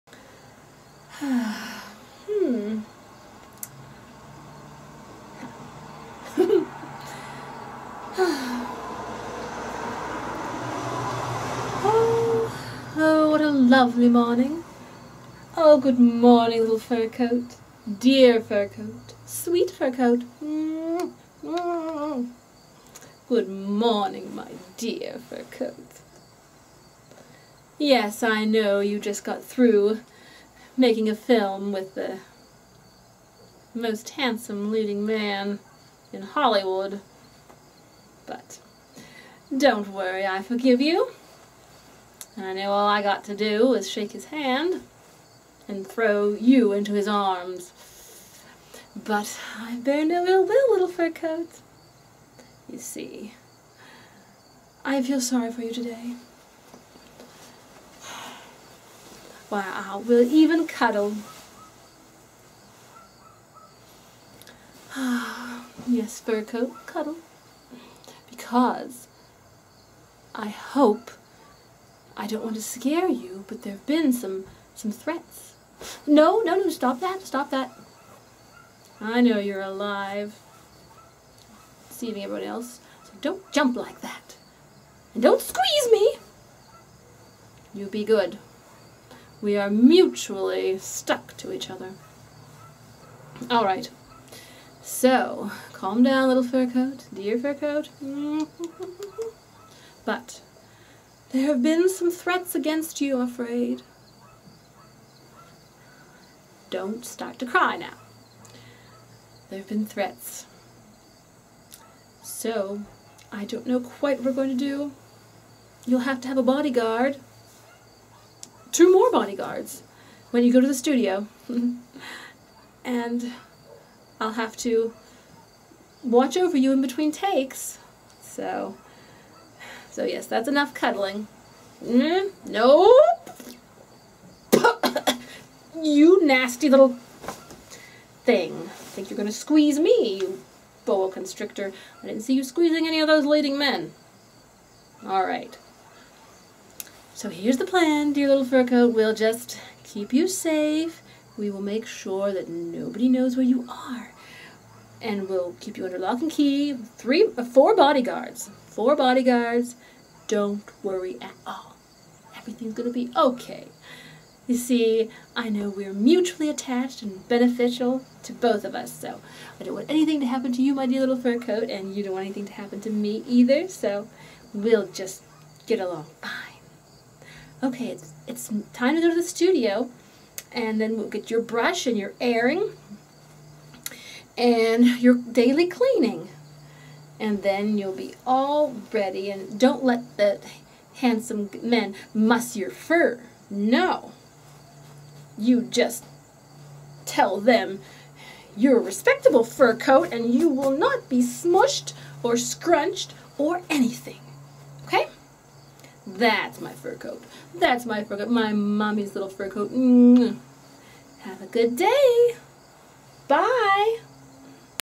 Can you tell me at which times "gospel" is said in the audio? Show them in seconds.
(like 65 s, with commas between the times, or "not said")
not said.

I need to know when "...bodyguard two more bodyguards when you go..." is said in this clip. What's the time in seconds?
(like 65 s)
116 s.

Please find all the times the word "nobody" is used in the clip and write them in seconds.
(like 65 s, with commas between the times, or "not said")
152 s.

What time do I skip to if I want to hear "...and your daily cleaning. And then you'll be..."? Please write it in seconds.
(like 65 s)
184 s.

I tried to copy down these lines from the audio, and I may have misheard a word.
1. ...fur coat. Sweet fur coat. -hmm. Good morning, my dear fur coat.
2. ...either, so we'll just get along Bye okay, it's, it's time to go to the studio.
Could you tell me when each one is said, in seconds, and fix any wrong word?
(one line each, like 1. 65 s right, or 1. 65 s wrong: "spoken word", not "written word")
1. 18 s right
2. 173 s right.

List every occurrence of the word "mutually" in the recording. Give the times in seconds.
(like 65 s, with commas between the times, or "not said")
89 s, 165 s.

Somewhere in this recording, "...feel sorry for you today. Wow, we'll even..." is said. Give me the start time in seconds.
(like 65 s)
55 s.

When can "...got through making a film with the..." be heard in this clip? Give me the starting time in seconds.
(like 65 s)
29 s.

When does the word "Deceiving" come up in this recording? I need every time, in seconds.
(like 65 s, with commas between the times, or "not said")
81 s.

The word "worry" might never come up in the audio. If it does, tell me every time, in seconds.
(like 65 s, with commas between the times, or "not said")
39 s, 160 s.